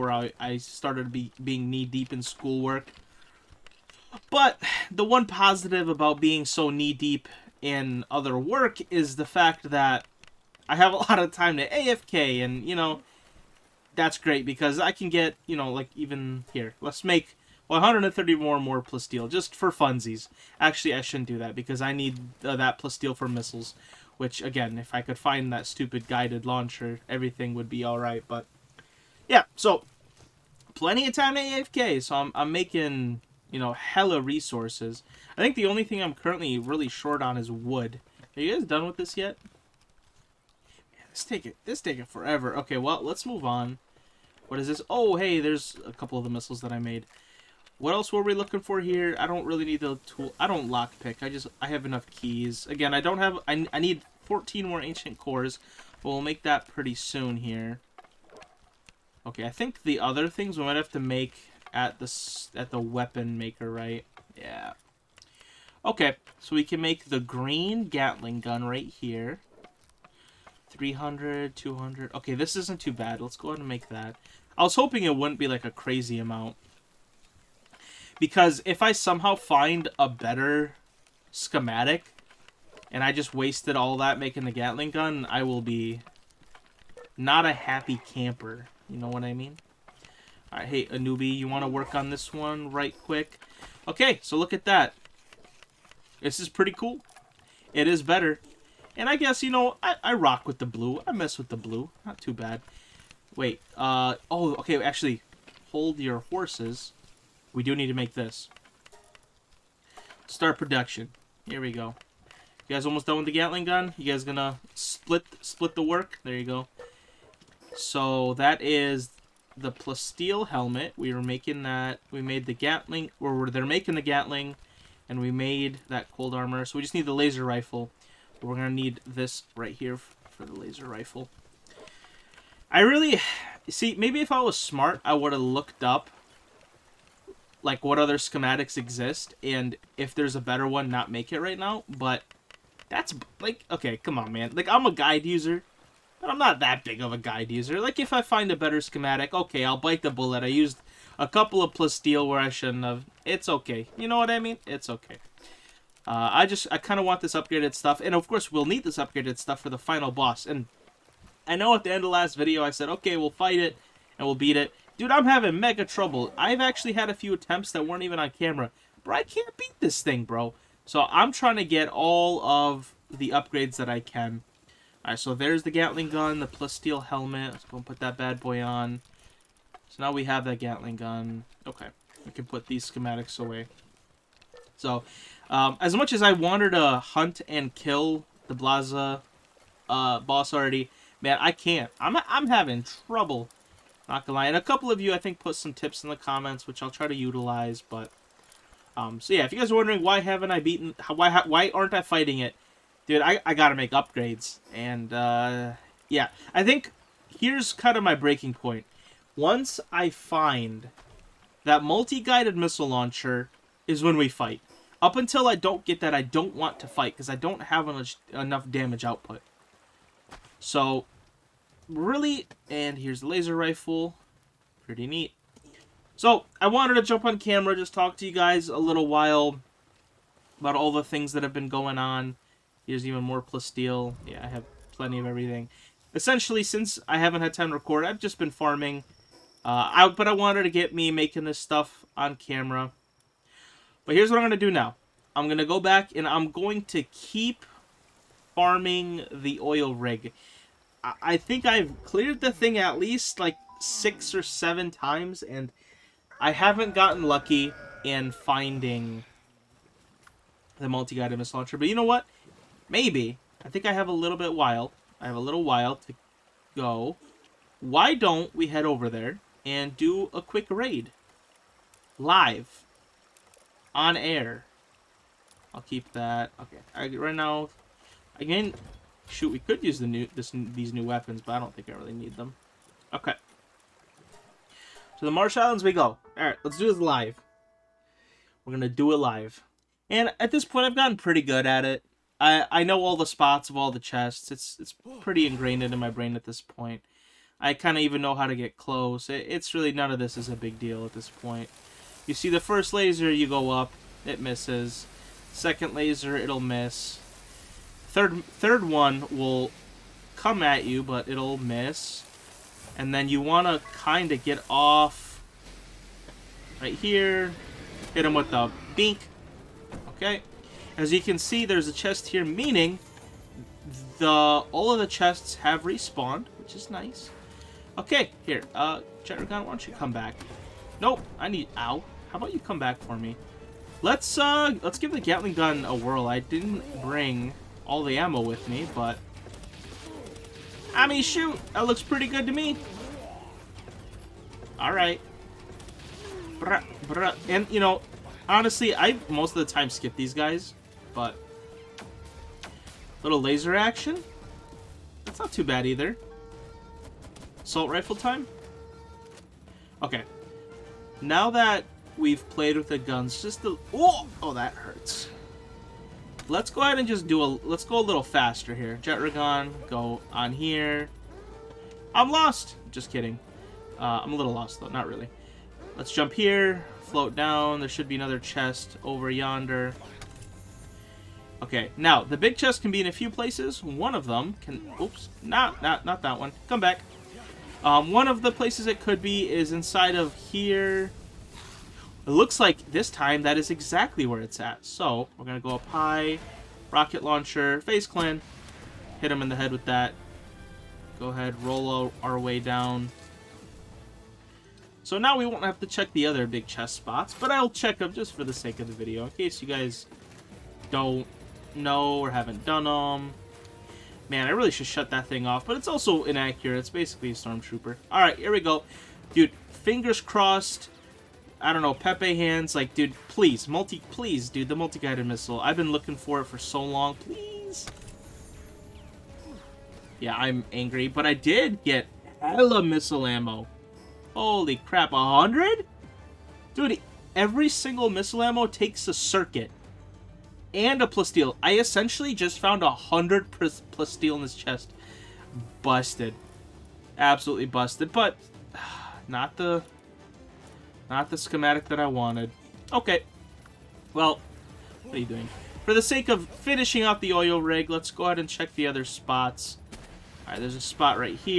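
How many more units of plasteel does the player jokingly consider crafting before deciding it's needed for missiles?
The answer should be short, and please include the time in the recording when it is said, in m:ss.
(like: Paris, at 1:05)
130, at 0:17.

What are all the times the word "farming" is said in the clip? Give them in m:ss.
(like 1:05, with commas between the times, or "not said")
3:58, 4:08.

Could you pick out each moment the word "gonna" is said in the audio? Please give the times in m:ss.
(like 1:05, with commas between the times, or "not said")
1:54, 2:08, 3:14, 4:48.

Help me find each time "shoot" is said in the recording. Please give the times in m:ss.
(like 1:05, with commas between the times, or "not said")
4:39, 5:41.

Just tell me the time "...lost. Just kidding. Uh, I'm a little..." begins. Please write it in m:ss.
6:12.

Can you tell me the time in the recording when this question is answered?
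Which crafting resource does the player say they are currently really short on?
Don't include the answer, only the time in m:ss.
0:37.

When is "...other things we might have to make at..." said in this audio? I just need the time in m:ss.
0:59.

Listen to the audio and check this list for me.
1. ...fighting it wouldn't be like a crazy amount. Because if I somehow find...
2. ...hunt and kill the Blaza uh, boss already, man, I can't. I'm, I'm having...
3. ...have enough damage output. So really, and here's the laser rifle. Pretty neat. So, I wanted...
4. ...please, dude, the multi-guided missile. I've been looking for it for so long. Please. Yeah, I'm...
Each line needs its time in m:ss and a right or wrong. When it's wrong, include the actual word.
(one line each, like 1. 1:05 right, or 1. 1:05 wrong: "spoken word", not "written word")
1. 1:14 wrong: "hoping", not "fighting"
2. 3:06 right
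3. 3:37 right
4. 7:04 right.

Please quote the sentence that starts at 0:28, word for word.
But yeah, so plenty of time to AFK.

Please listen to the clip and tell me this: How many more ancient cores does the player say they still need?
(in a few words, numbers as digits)
14.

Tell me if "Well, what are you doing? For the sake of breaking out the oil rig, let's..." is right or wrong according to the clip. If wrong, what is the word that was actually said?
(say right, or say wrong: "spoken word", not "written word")
wrong: "finishing", not "breaking".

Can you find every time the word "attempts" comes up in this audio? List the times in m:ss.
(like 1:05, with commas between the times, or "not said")
2:47.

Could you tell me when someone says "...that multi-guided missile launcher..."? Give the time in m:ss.
3:31.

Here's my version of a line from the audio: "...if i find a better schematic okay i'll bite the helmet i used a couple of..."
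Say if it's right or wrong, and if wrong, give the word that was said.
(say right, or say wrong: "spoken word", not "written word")
wrong: "bullet", not "helmet".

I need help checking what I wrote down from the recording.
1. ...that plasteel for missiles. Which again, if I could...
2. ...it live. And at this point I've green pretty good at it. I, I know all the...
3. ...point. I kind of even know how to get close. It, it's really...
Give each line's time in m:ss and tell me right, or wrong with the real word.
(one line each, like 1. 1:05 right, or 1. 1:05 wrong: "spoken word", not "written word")
1. 0:22 right
2. 4:49 wrong: "gotten", not "green"
3. 4:56 right.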